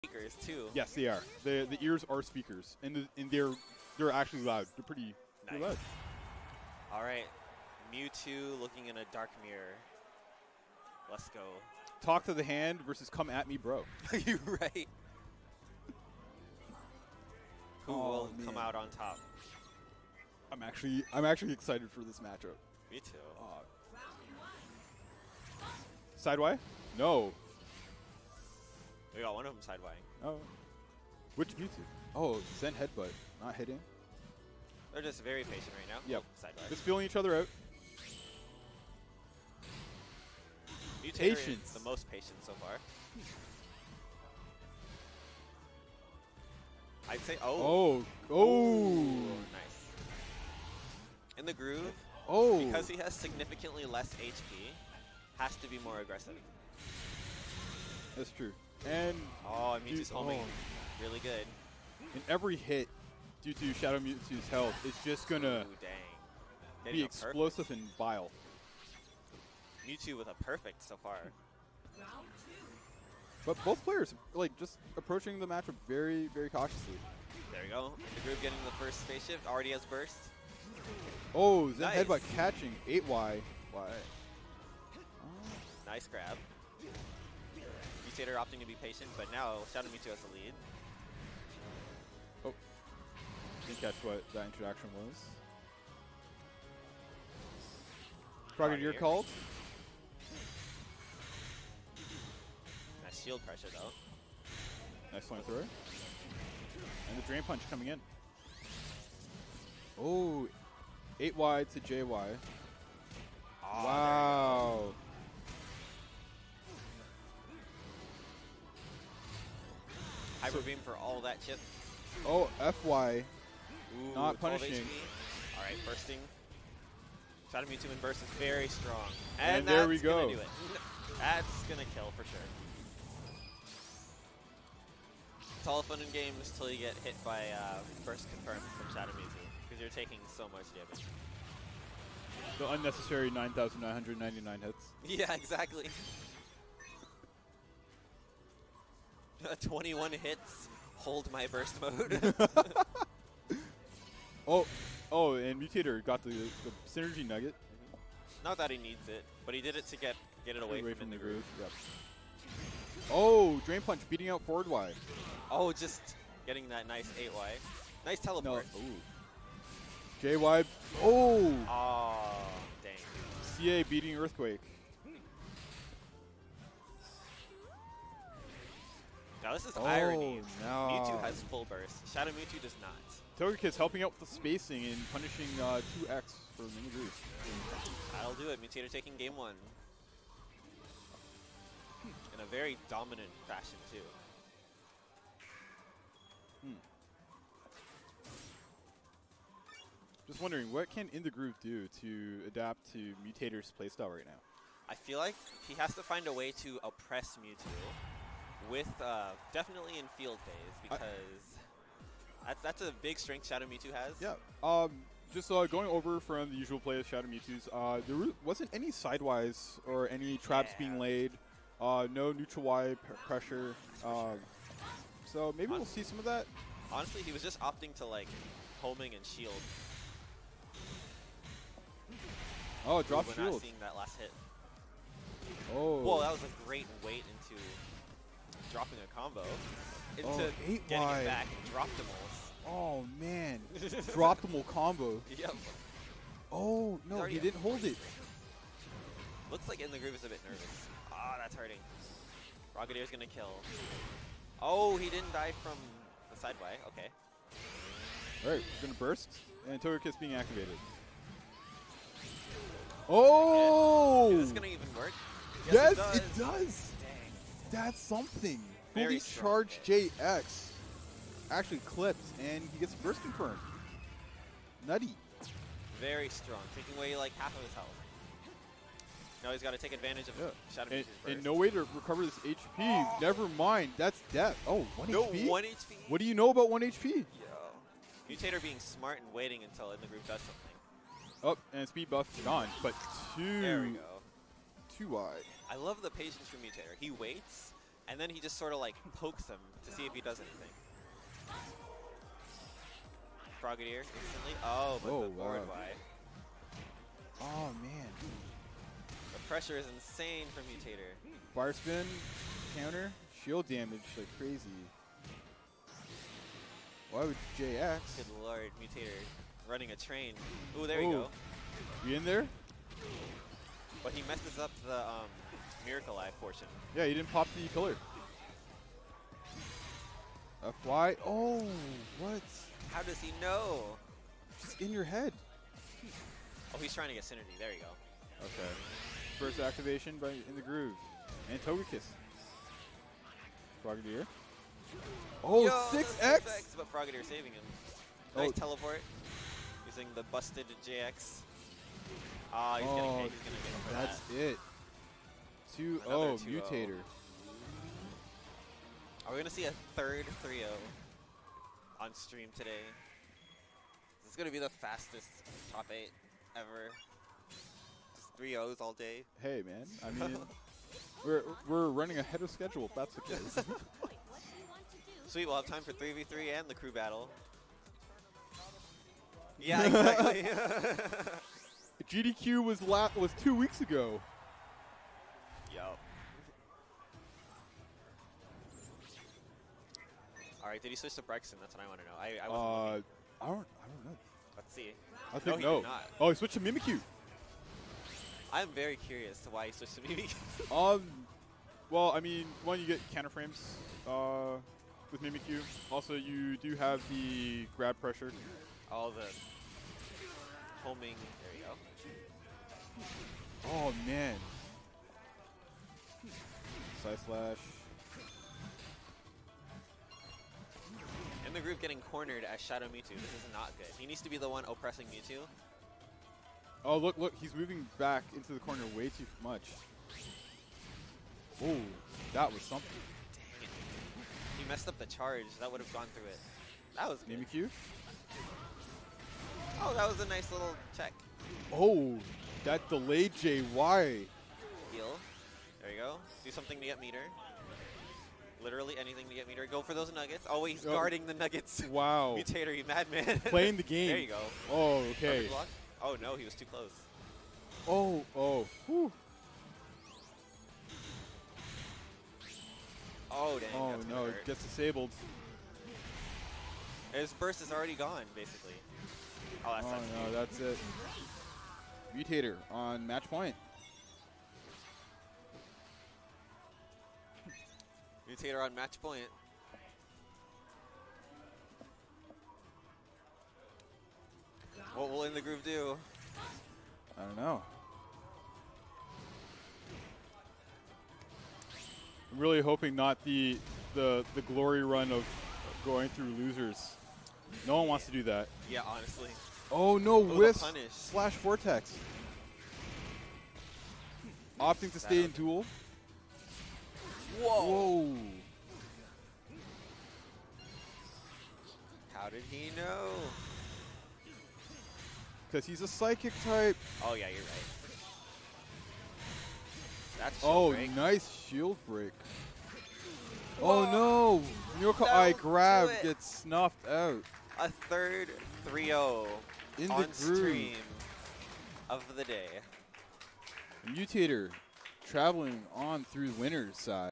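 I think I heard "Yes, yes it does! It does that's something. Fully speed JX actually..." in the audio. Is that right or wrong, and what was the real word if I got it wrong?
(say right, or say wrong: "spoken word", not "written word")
wrong: "charged", not "speed".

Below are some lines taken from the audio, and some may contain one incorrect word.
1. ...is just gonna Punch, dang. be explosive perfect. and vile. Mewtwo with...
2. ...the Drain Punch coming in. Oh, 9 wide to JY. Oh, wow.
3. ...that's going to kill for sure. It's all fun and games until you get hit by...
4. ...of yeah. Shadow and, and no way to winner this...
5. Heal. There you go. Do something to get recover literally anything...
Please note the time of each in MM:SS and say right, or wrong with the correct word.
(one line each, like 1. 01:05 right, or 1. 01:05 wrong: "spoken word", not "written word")
1. 01:04 wrong: "Ooh", not "Punch"
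2. 01:47 wrong: "8", not "9"
3. 02:11 right
4. 04:40 wrong: "recover", not "winner"
5. 07:24 wrong: "meter", not "recover".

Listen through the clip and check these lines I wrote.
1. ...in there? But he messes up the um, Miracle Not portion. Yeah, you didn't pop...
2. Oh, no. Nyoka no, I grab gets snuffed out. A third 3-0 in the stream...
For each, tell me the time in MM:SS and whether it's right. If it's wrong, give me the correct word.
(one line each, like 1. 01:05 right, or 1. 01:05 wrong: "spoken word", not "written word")
1. 05:22 wrong: "Eye", not "Not"
2. 08:43 right.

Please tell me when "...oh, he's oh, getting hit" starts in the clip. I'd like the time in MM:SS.
05:52.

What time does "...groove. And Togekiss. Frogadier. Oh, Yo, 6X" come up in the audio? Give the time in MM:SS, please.
05:40.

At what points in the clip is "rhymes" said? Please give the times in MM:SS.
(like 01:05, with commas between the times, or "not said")
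not said.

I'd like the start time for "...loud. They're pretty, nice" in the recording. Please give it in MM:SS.
00:04.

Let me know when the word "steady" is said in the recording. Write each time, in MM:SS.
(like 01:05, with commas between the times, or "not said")
not said.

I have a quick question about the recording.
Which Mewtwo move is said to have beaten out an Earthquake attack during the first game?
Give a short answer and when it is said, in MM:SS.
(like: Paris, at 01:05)
CA, at 02:53.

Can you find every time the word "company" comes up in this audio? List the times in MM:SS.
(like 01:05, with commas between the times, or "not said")
not said.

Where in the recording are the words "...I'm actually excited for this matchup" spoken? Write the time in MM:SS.
00:21.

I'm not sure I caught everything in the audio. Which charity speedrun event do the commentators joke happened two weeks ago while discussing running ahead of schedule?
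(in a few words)
GDQ.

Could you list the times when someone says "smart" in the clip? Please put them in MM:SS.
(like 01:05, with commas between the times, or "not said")
04:48.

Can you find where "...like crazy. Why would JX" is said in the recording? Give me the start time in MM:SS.
05:14.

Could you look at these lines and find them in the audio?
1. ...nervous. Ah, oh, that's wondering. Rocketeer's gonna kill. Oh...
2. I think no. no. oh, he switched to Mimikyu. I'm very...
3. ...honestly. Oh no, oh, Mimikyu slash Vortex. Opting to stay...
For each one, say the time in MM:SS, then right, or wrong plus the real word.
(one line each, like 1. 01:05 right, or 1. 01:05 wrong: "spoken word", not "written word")
1. 04:10 wrong: "hurting", not "wondering"
2. 06:35 right
3. 08:18 wrong: "Wisp", not "Mimikyu".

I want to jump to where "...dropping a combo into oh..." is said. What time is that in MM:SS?
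03:58.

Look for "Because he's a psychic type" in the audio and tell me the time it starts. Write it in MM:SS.
08:35.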